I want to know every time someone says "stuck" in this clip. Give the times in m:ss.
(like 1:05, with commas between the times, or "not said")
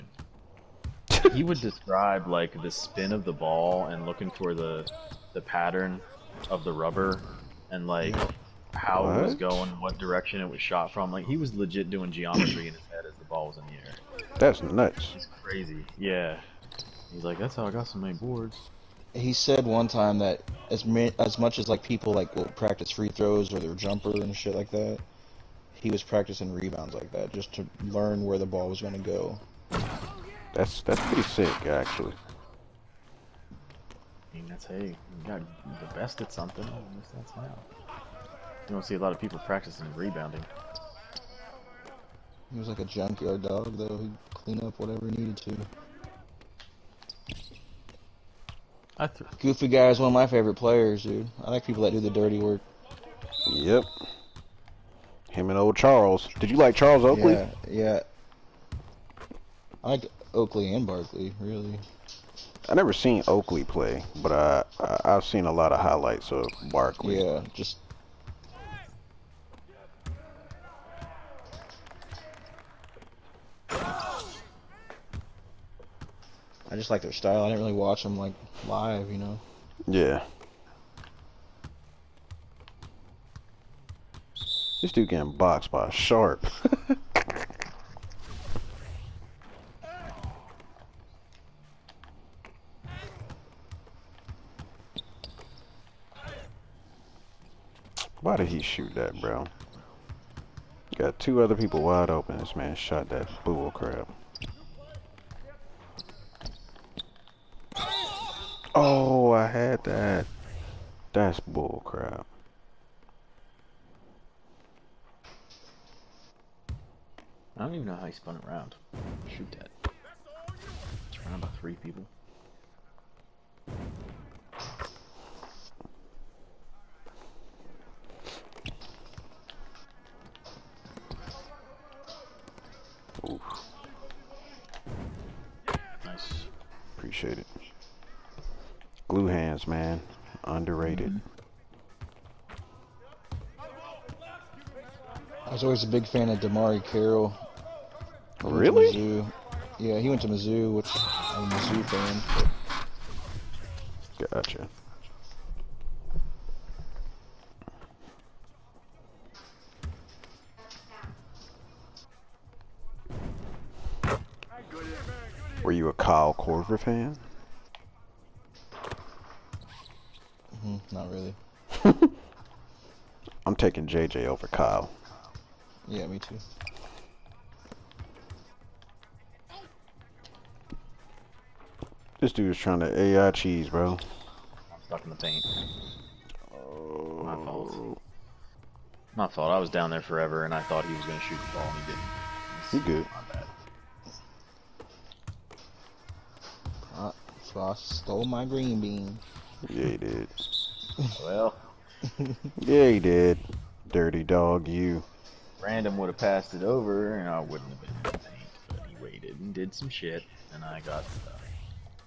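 3:04, 3:31.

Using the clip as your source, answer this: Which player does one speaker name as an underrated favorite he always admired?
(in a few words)
DeMarre Carroll.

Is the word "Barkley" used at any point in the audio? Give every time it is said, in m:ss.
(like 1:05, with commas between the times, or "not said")
1:00, 1:06.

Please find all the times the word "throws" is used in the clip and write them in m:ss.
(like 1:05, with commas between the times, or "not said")
0:23.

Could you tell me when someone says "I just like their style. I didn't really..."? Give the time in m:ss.
1:13.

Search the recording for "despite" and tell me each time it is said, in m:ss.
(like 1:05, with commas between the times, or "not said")
not said.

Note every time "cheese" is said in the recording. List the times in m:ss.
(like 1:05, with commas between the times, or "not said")
3:03.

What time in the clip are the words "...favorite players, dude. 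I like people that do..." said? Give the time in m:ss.
0:50.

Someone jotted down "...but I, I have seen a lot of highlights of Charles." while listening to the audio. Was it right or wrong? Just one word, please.
wrong.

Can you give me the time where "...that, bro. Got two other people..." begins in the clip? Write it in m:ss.
1:38.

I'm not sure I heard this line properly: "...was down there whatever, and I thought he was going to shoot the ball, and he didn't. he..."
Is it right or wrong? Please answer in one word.
wrong.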